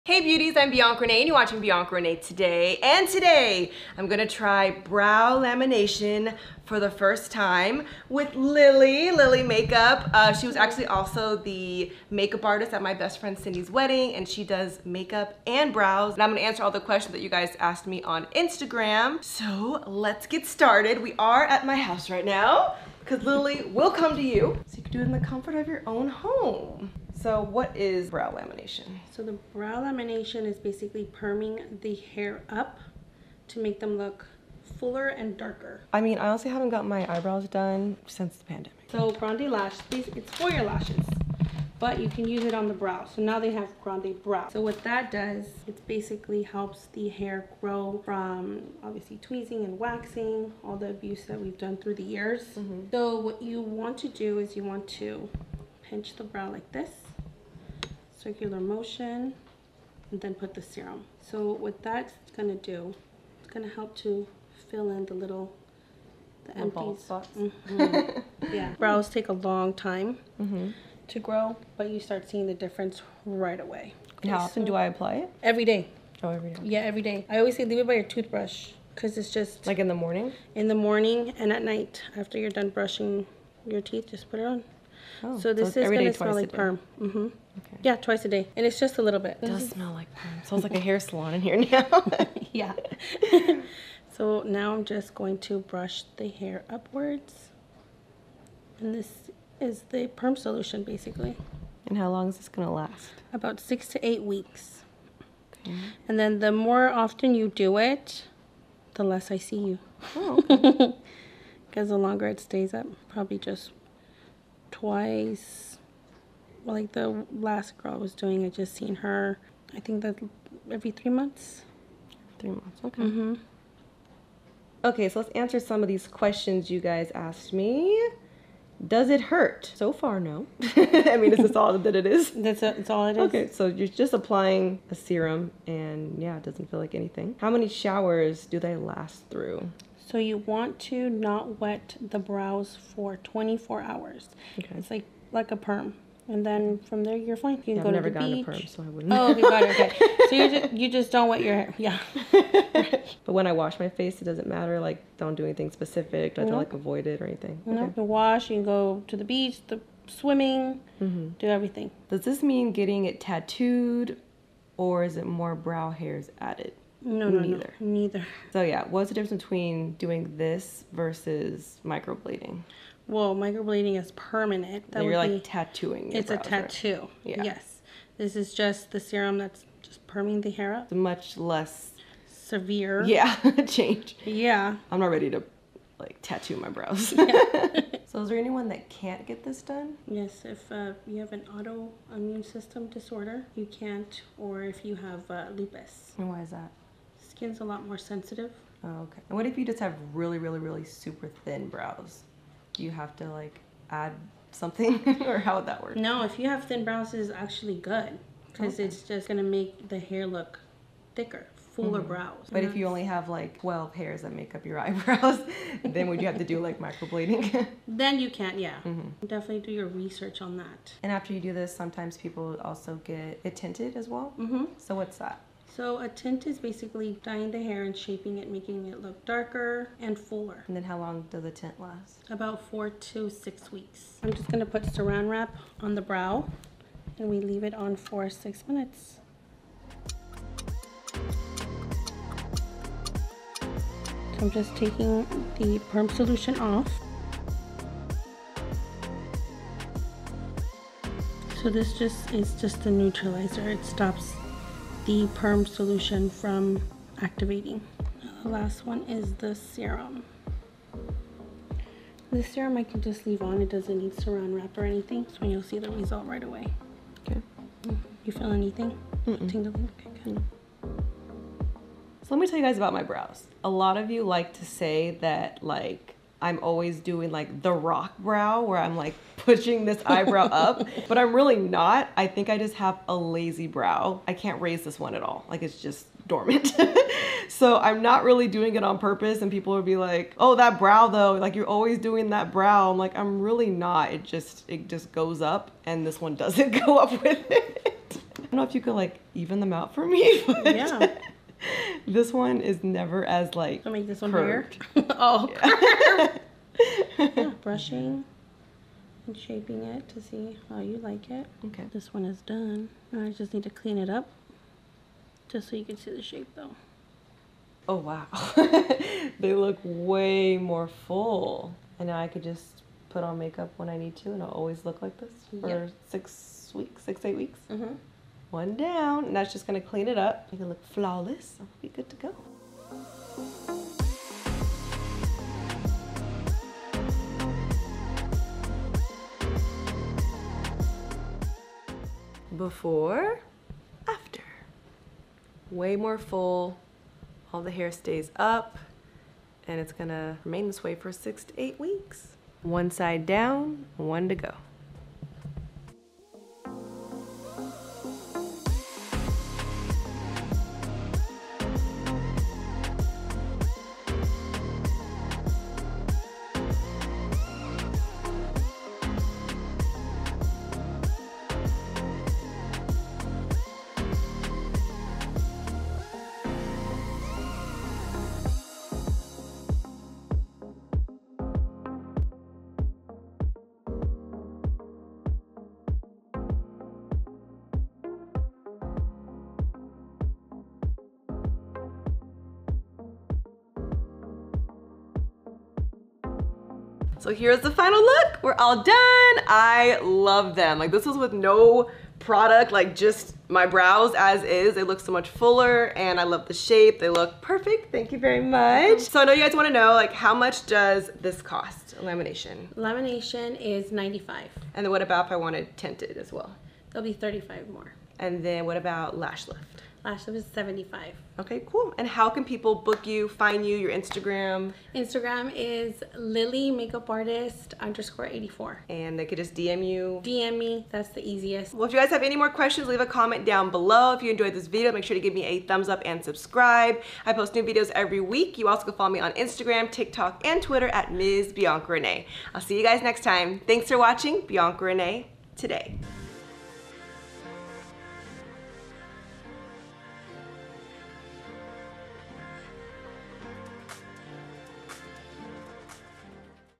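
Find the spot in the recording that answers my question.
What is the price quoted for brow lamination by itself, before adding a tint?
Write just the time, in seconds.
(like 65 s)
413 s.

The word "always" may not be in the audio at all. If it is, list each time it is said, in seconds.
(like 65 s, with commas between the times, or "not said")
77 s, 276 s, 291 s, 324 s.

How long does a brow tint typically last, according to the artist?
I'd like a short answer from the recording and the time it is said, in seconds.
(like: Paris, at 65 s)
4 to 6 weeks, at 232 s.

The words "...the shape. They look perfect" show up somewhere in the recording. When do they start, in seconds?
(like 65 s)
406 s.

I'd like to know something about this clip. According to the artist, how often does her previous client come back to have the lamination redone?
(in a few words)
Every 3 months.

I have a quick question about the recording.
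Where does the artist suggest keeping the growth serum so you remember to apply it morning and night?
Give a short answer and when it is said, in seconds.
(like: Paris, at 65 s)
By your toothbrush, at 77 s.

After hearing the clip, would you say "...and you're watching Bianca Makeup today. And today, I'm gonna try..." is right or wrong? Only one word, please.
wrong.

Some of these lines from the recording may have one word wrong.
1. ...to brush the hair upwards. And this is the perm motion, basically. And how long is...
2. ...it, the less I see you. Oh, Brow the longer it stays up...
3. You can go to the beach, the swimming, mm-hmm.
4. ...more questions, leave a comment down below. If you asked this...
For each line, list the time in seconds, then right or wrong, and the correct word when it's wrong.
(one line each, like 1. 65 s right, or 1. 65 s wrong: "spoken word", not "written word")
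1. 95 s wrong: "solution", not "motion"
2. 107 s wrong: "Because", not "Brow"
3. 158 s right
4. 432 s wrong: "enjoyed", not "asked".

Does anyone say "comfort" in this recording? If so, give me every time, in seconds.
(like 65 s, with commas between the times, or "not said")
25 s.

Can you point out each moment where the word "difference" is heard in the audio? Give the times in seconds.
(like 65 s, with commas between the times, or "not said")
72 s, 169 s.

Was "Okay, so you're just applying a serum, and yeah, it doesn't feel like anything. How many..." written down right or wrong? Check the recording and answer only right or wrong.
right.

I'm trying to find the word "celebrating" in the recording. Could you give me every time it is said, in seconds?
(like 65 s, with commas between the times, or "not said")
not said.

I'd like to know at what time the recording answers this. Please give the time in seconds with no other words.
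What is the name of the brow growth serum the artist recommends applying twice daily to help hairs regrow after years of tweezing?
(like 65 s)
43 s.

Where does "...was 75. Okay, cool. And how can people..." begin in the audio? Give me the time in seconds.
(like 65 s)
420 s.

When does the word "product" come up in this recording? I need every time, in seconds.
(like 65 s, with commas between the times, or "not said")
402 s.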